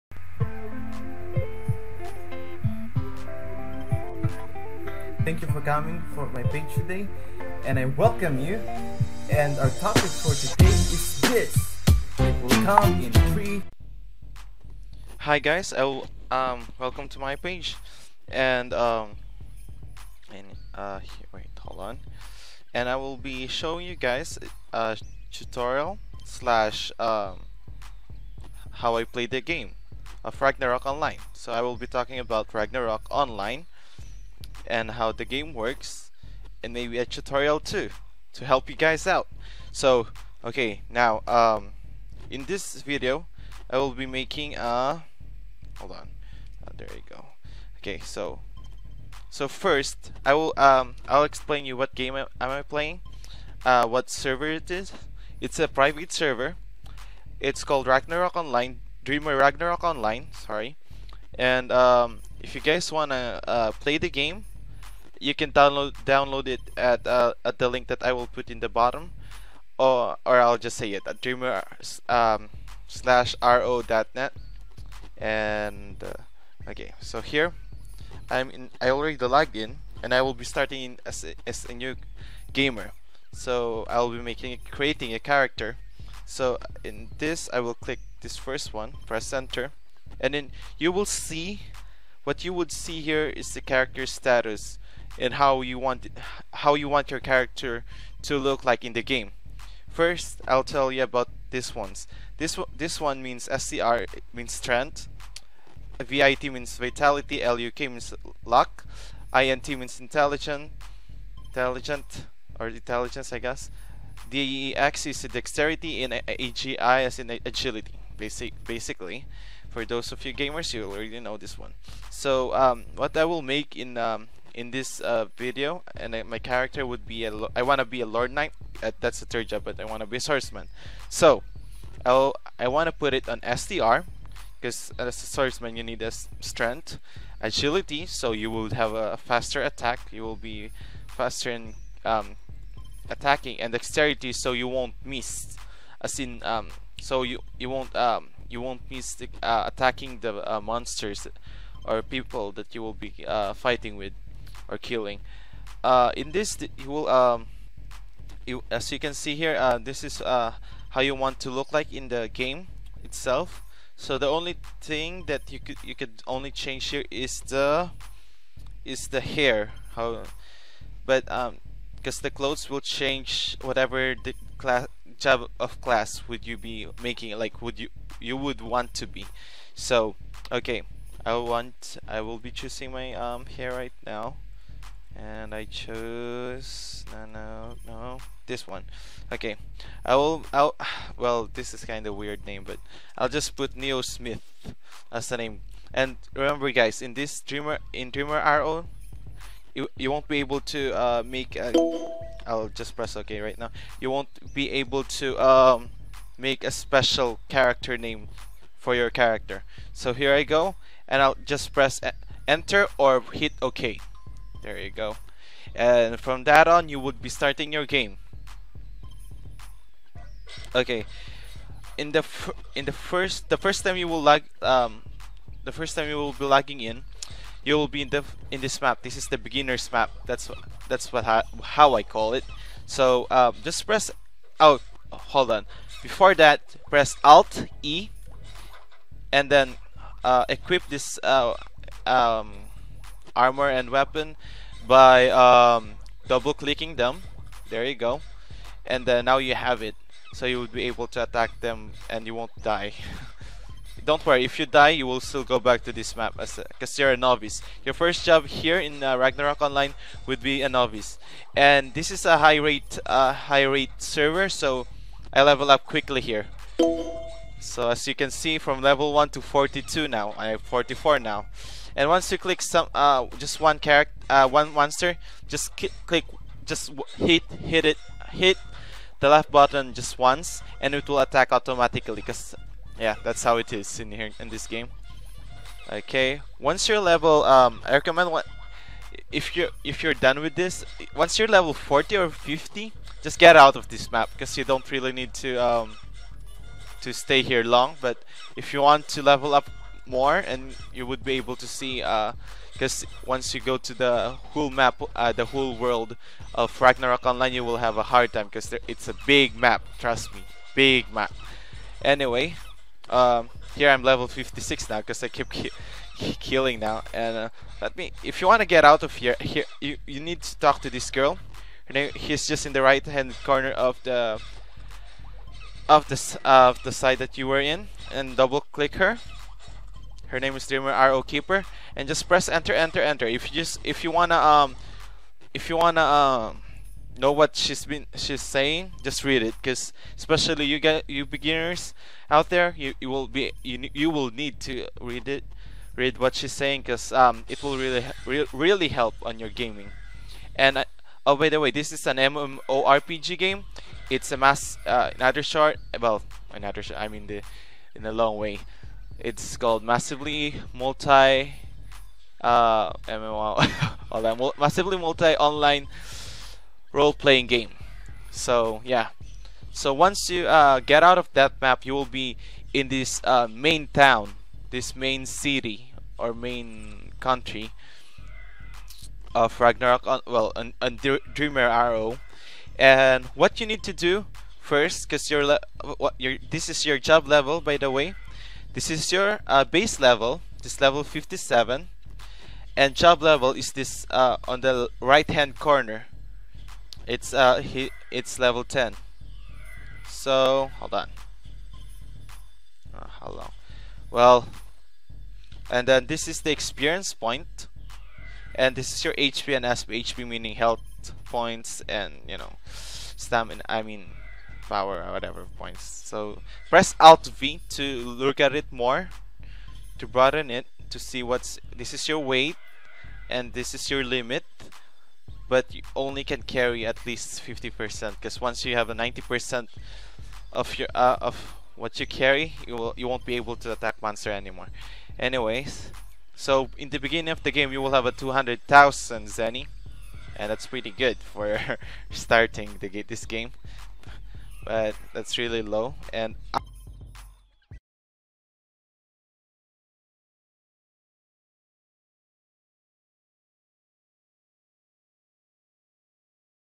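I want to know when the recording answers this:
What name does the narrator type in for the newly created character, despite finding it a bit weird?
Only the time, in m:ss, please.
3:13.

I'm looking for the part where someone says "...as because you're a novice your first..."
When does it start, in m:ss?
4:16.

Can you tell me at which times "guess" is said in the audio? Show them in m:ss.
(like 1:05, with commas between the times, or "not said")
1:53.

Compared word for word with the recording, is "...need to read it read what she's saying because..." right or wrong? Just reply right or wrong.
right.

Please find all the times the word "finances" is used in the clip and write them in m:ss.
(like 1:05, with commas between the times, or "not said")
not said.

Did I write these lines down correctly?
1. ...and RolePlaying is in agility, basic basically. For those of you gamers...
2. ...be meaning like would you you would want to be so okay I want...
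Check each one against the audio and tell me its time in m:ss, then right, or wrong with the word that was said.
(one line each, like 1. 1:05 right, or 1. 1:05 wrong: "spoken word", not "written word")
1. 1:56 wrong: "AGI", not "RolePlaying"
2. 2:56 wrong: "making", not "meaning".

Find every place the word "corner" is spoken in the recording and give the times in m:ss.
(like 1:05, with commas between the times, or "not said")
5:23, 6:35.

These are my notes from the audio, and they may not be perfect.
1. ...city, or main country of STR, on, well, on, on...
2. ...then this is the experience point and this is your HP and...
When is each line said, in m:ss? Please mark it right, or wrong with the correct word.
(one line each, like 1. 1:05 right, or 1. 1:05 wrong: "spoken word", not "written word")
1. 6:15 wrong: "Ragnarok", not "STR"
2. 6:45 right.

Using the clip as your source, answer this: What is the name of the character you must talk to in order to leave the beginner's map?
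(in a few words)
Dreamer RO Keeper.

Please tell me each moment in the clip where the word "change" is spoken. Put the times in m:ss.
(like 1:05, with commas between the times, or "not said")
2:46, 2:52.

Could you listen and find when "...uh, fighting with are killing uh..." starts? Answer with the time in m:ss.
2:33.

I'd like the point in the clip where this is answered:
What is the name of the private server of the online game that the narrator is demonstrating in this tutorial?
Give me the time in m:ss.
0:59.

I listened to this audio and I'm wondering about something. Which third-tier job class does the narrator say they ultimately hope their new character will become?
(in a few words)
Lord Knight.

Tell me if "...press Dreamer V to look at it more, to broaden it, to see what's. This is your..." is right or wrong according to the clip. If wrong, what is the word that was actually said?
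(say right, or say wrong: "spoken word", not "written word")
wrong: "Alt", not "Dreamer".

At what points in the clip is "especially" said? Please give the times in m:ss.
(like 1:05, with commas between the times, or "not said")
5:40.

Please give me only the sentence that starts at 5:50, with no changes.
And uh, Oh, by the way, this is an MMORPG game.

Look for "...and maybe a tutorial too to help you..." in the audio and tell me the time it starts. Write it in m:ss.
0:36.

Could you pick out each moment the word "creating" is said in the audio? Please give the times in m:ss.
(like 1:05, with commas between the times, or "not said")
1:24.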